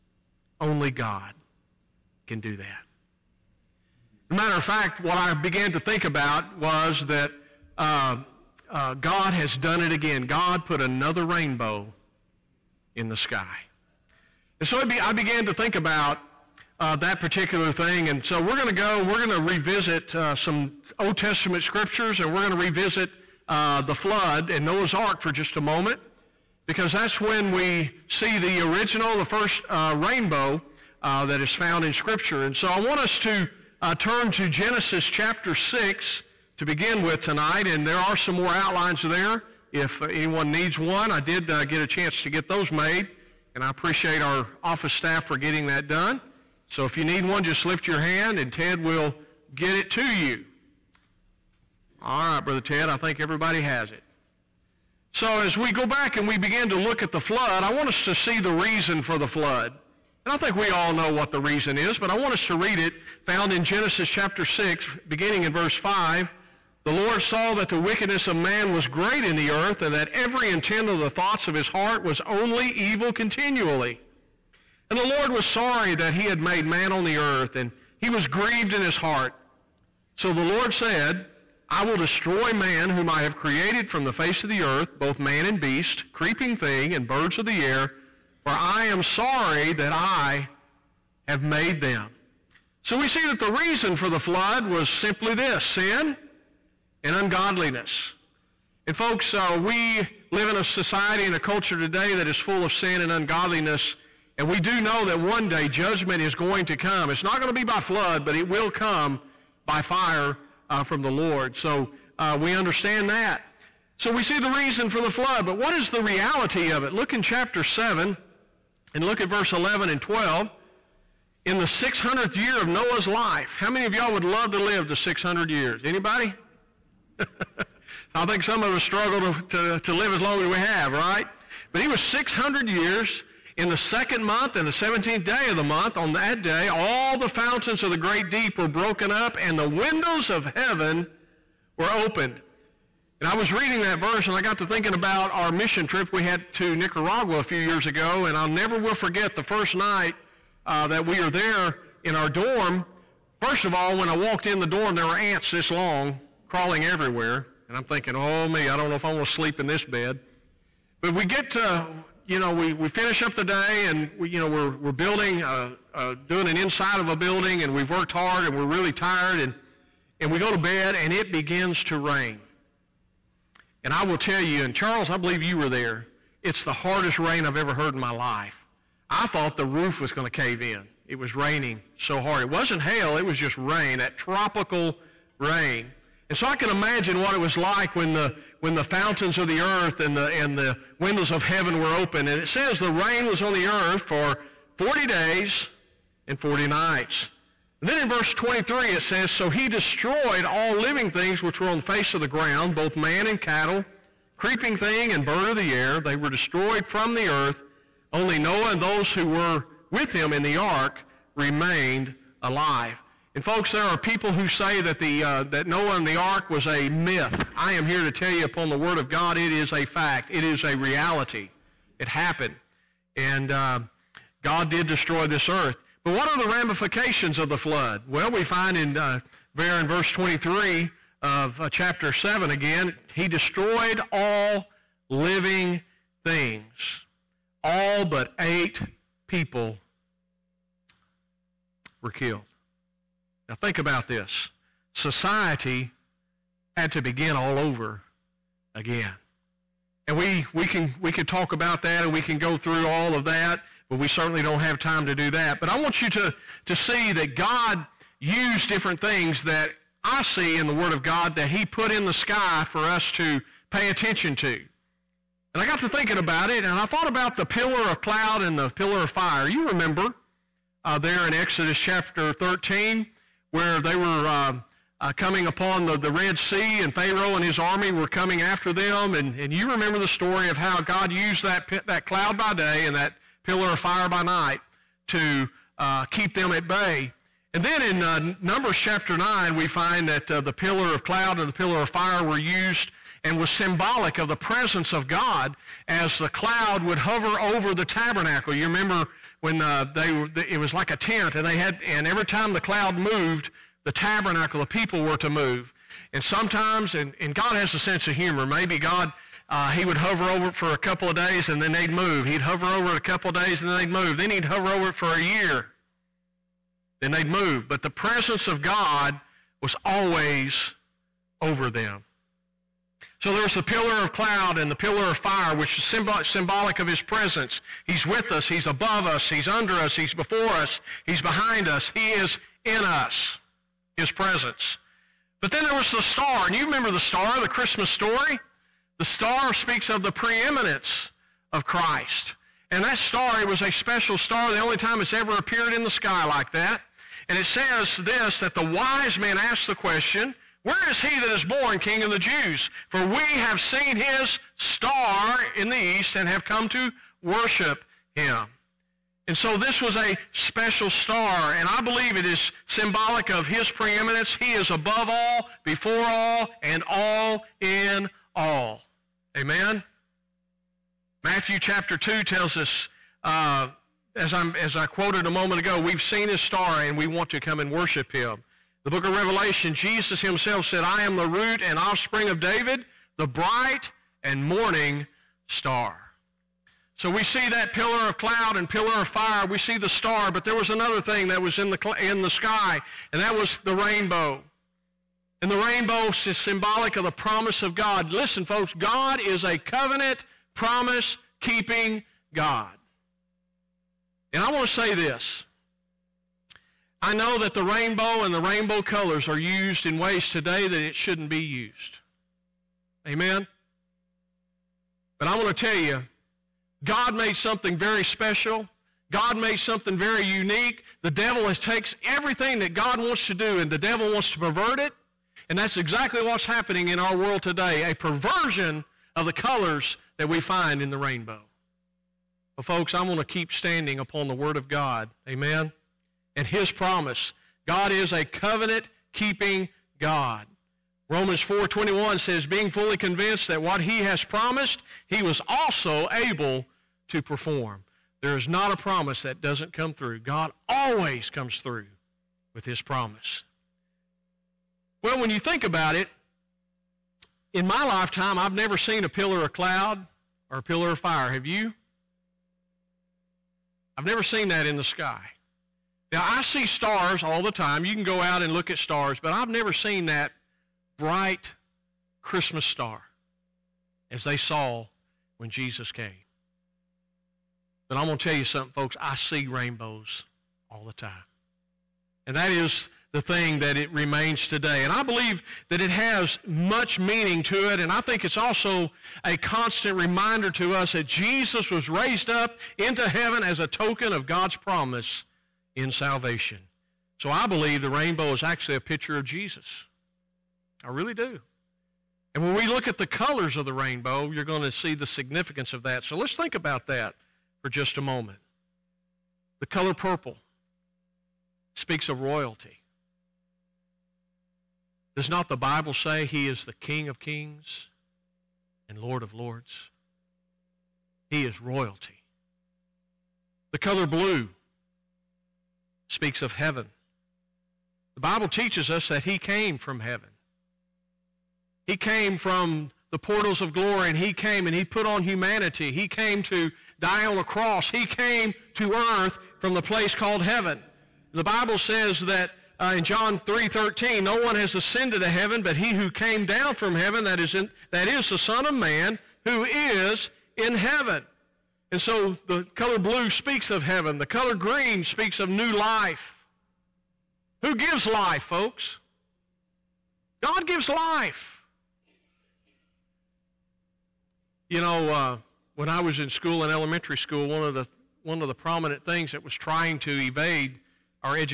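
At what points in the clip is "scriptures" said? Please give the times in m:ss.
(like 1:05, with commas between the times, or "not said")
0:21, 0:31.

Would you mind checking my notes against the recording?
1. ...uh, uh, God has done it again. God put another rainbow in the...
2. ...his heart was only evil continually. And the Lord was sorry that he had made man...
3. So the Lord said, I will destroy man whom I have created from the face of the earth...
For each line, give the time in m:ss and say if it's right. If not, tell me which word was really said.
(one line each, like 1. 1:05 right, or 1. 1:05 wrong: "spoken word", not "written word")
1. 0:07 right
2. 1:11 right
3. 1:20 right.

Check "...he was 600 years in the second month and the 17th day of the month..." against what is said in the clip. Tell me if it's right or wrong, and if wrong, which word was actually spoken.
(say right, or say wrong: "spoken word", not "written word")
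right.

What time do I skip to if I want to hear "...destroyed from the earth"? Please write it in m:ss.
3:26.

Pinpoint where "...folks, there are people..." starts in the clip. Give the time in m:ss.
3:33.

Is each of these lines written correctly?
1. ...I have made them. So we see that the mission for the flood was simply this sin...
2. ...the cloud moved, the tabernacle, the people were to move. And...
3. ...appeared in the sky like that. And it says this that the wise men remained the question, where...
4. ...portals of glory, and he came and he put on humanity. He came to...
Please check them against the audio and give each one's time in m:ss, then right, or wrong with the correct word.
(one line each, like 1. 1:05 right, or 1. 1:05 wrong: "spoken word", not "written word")
1. 1:29 wrong: "reason", not "mission"
2. 5:02 right
3. 5:45 wrong: "asked", not "remained"
4. 8:53 right.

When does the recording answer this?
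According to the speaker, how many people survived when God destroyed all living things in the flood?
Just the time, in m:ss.
3:58.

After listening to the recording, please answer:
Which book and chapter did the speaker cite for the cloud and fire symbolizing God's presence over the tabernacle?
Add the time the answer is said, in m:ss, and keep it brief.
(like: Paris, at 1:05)
Numbers 9, at 4:48.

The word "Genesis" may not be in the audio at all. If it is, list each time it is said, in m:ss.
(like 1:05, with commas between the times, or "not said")
0:34, 1:03.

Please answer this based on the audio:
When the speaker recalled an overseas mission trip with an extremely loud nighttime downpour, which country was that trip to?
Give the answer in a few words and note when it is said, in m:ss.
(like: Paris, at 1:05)
Nicaragua, at 2:26.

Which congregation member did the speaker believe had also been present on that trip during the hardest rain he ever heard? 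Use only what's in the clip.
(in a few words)
Charles.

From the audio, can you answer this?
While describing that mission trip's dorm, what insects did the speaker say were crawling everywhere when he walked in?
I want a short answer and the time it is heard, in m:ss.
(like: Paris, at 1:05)
ants, at 2:35.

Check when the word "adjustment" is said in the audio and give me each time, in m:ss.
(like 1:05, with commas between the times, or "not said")
not said.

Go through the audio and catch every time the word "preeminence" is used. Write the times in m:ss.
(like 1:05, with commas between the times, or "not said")
5:40, 6:03.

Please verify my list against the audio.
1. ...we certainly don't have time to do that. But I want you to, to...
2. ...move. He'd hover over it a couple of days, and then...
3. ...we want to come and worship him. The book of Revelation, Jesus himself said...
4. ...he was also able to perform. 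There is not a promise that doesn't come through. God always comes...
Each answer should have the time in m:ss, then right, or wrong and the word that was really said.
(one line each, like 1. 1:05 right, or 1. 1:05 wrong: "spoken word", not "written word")
1. 4:13 right
2. 5:11 right
3. 6:16 right
4. 7:25 right.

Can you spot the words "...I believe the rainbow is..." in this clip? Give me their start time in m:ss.
8:17.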